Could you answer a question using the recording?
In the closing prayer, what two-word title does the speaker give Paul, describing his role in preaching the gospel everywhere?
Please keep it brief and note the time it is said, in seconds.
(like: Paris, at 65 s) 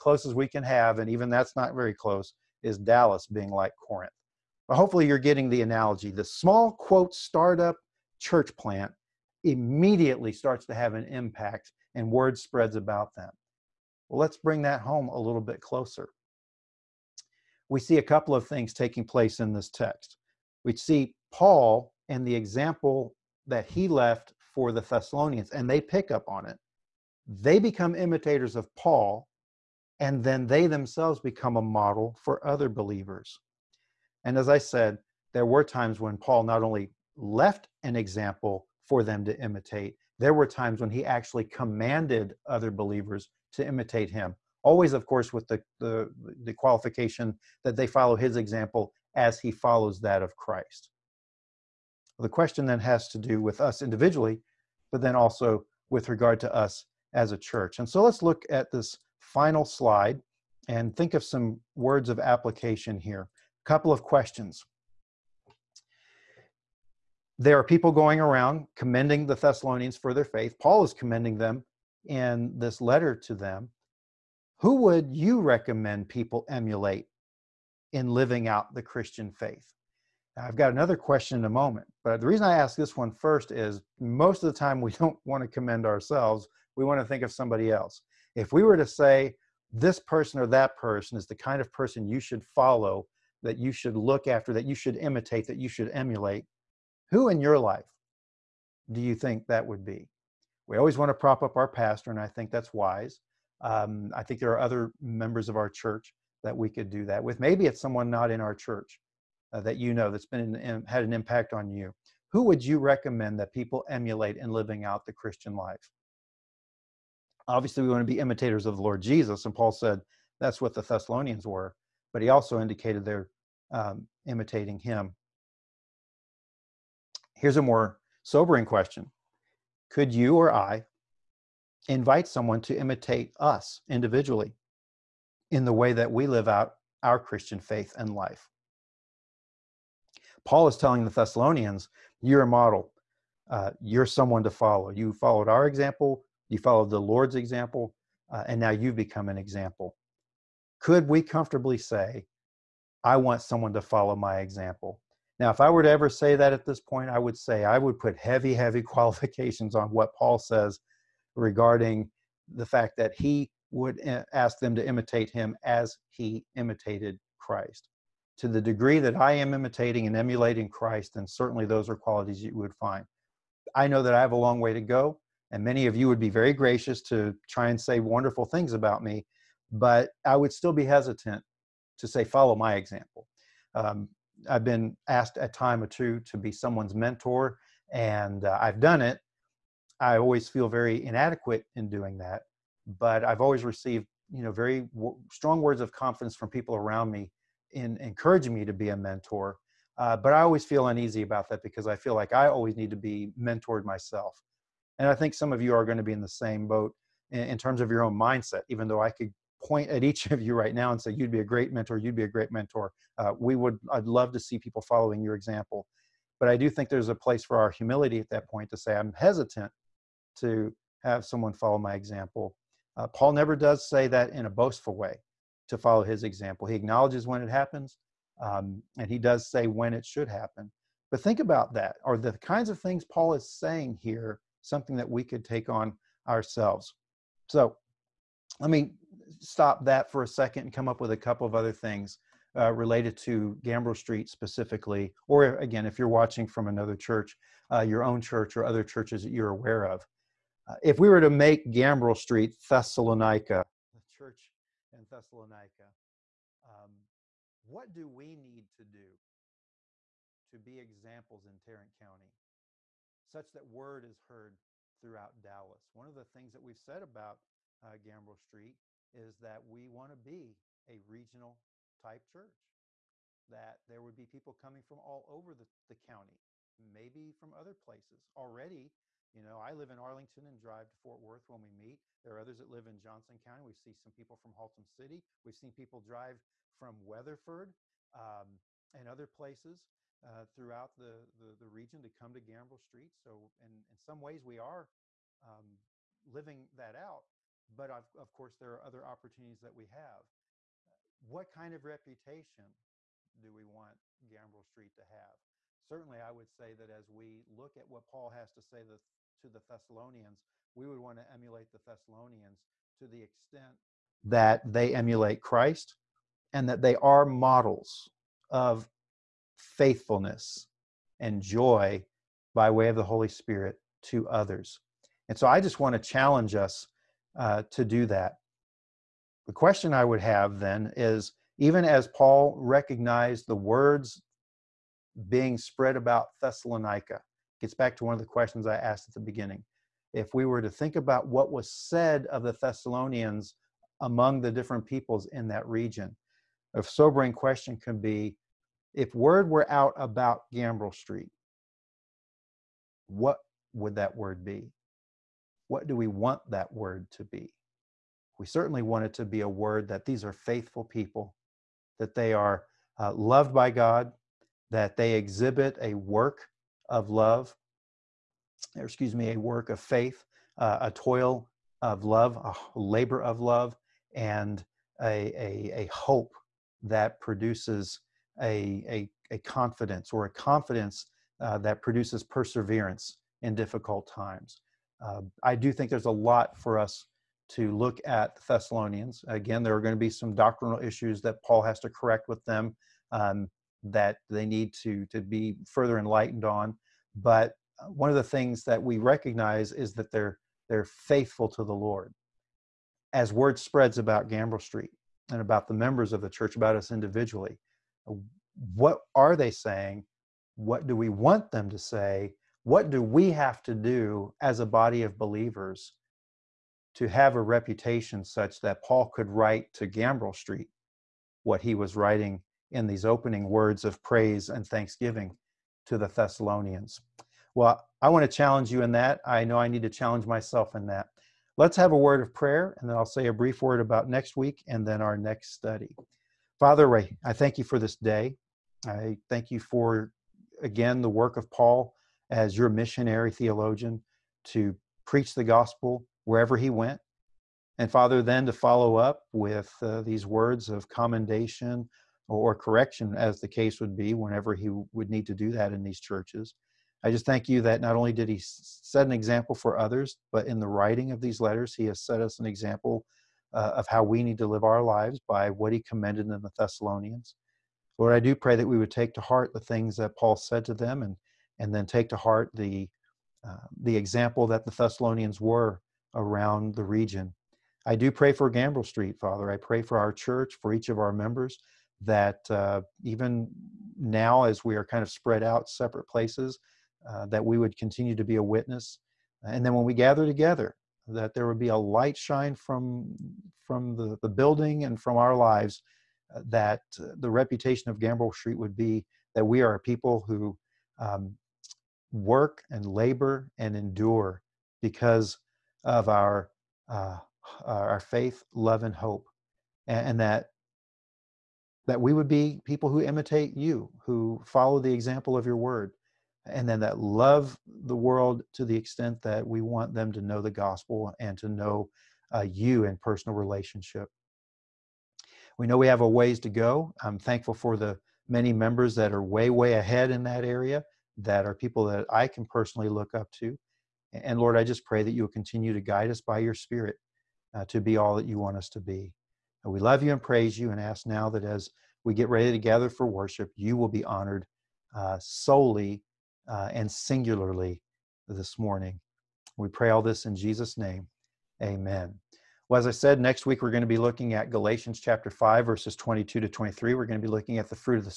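missionary theologian, at 442 s.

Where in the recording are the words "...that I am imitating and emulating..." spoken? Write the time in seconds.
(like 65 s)
168 s.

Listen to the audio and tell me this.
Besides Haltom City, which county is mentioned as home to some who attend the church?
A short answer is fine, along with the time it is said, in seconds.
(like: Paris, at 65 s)
Johnson County, at 282 s.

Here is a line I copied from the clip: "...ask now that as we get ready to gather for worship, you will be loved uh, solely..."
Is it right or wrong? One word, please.
wrong.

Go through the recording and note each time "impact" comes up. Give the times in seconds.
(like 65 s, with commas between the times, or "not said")
11 s, 111 s.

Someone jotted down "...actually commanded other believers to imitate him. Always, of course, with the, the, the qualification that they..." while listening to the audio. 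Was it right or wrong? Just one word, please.
right.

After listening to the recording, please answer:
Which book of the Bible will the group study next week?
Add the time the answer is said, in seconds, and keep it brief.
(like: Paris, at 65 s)
Galatians, at 554 s.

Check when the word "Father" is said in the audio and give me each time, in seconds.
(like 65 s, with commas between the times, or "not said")
436 s, 447 s, 479 s.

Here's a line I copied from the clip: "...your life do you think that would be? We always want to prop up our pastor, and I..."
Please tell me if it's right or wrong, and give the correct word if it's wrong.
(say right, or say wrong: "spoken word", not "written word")
right.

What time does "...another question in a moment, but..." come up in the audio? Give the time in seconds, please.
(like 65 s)
80 s.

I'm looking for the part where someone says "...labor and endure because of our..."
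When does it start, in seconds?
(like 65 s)
502 s.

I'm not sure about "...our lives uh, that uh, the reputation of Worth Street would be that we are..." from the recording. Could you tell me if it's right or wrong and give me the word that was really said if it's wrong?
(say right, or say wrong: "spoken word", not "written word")
wrong: "Gambrell", not "Worth".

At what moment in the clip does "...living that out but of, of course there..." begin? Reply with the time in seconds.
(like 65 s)
296 s.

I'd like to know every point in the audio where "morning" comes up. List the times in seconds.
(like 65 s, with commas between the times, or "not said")
548 s.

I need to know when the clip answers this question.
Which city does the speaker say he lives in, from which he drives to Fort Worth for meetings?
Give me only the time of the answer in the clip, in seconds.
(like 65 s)
279 s.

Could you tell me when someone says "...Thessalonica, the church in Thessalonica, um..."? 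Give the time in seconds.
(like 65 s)
252 s.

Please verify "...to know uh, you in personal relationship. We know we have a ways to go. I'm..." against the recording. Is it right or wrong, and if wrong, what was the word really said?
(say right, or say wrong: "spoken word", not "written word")
right.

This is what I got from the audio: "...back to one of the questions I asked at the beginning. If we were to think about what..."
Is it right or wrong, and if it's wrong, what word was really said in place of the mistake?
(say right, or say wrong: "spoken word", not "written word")
right.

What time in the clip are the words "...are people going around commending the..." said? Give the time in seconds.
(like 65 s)
67 s.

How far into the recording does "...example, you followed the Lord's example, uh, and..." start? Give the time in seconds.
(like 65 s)
145 s.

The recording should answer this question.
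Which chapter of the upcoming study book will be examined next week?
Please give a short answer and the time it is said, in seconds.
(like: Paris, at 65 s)
5, at 555 s.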